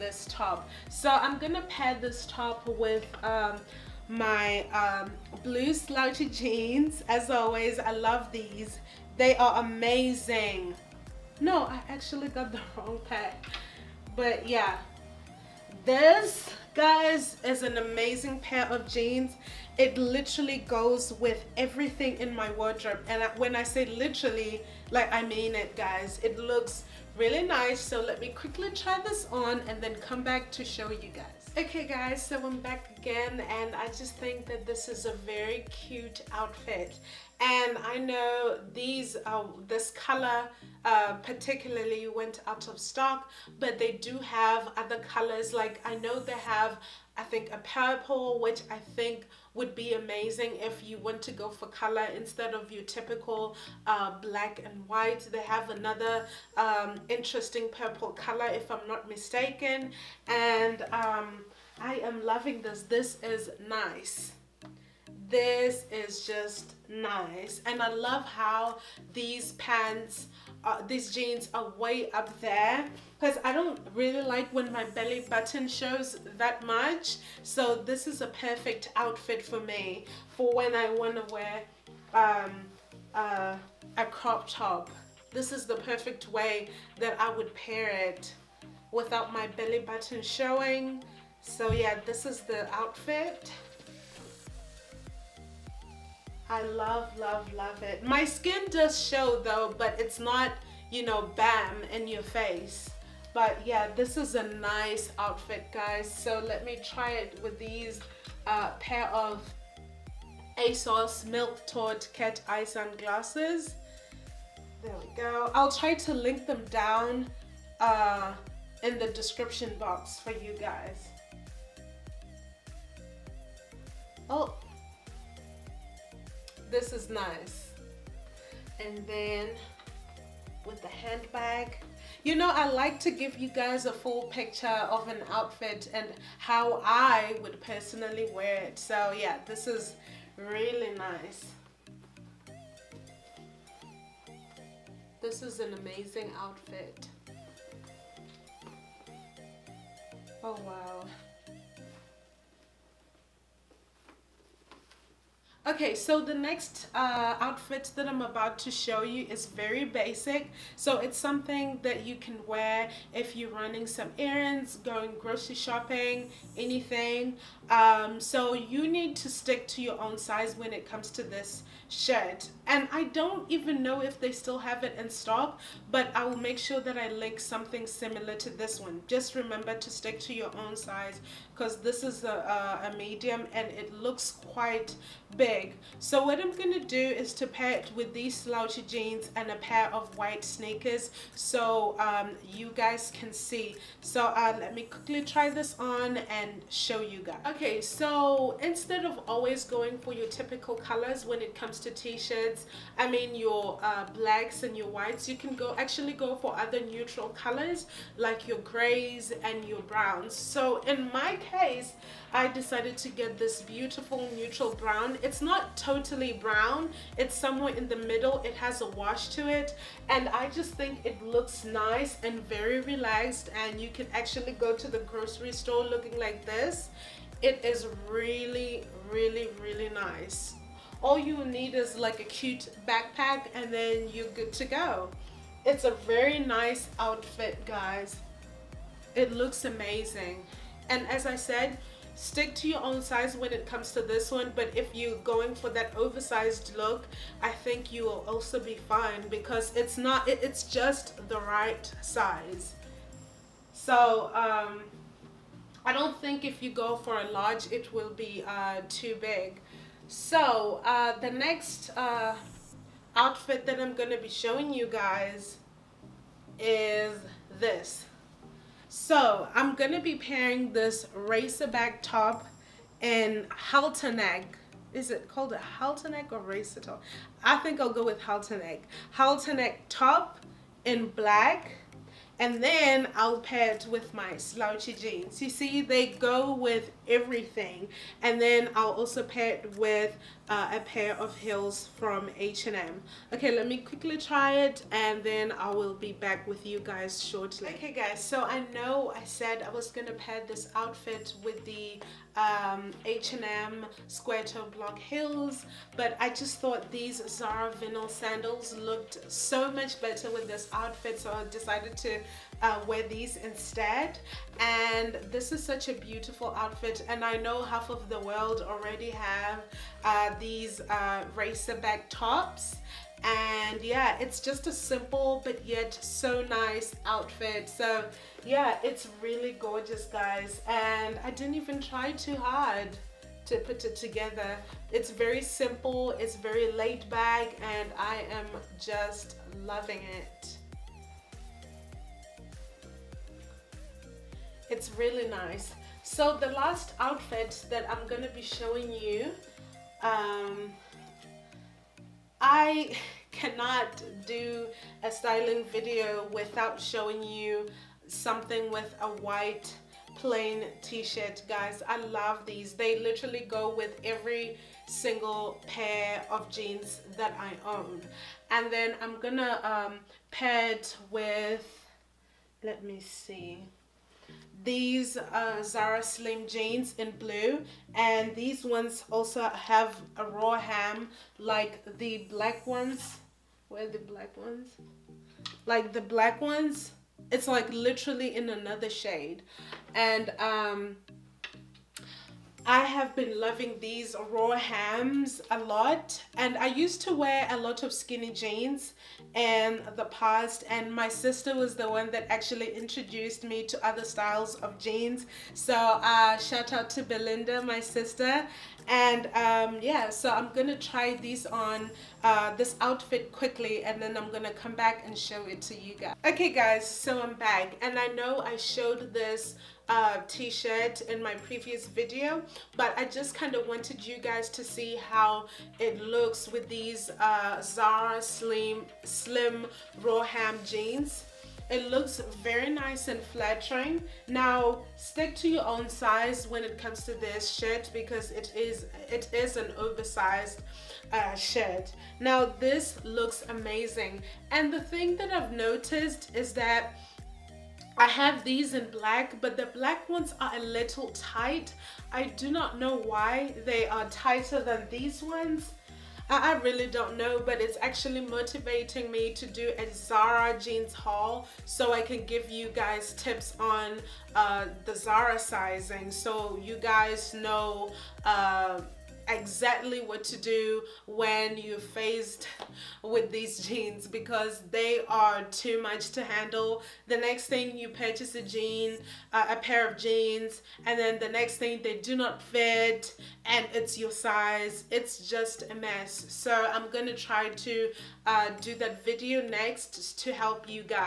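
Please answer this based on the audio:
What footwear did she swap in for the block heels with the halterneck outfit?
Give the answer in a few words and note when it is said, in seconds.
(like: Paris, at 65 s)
Zara vinyl sandals, at 307 s.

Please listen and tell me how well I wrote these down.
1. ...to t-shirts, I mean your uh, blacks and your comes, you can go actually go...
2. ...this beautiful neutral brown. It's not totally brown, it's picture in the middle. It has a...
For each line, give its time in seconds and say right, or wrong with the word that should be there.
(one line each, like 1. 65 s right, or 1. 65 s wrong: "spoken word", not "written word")
1. 201 s wrong: "whites", not "comes"
2. 213 s wrong: "somewhere", not "picture".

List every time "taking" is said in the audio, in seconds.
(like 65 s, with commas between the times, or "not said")
not said.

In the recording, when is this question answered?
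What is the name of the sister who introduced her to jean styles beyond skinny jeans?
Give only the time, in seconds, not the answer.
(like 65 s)
407 s.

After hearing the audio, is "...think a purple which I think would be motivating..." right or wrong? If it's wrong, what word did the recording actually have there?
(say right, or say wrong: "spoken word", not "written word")
wrong: "amazing", not "motivating".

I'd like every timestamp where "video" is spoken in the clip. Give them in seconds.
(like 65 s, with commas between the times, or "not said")
355 s, 421 s, 489 s.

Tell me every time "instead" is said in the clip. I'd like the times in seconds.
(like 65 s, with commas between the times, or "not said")
52 s, 198 s, 313 s.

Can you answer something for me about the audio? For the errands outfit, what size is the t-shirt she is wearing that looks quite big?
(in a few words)
Medium.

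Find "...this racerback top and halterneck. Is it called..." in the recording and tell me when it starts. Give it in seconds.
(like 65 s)
270 s.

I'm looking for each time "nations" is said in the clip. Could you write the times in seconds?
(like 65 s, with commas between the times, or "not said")
not said.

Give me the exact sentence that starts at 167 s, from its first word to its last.
Um, so you need to stick to your own size when it comes to this shirt.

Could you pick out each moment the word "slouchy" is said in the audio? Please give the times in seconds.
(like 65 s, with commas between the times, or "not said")
5 s, 188 s, 284 s.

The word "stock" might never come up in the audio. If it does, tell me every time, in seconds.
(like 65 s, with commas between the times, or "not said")
42 s, 175 s.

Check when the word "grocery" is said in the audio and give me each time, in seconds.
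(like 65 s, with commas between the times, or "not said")
165 s, 224 s.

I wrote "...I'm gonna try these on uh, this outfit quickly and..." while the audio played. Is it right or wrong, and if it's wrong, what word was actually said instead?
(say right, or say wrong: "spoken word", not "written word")
right.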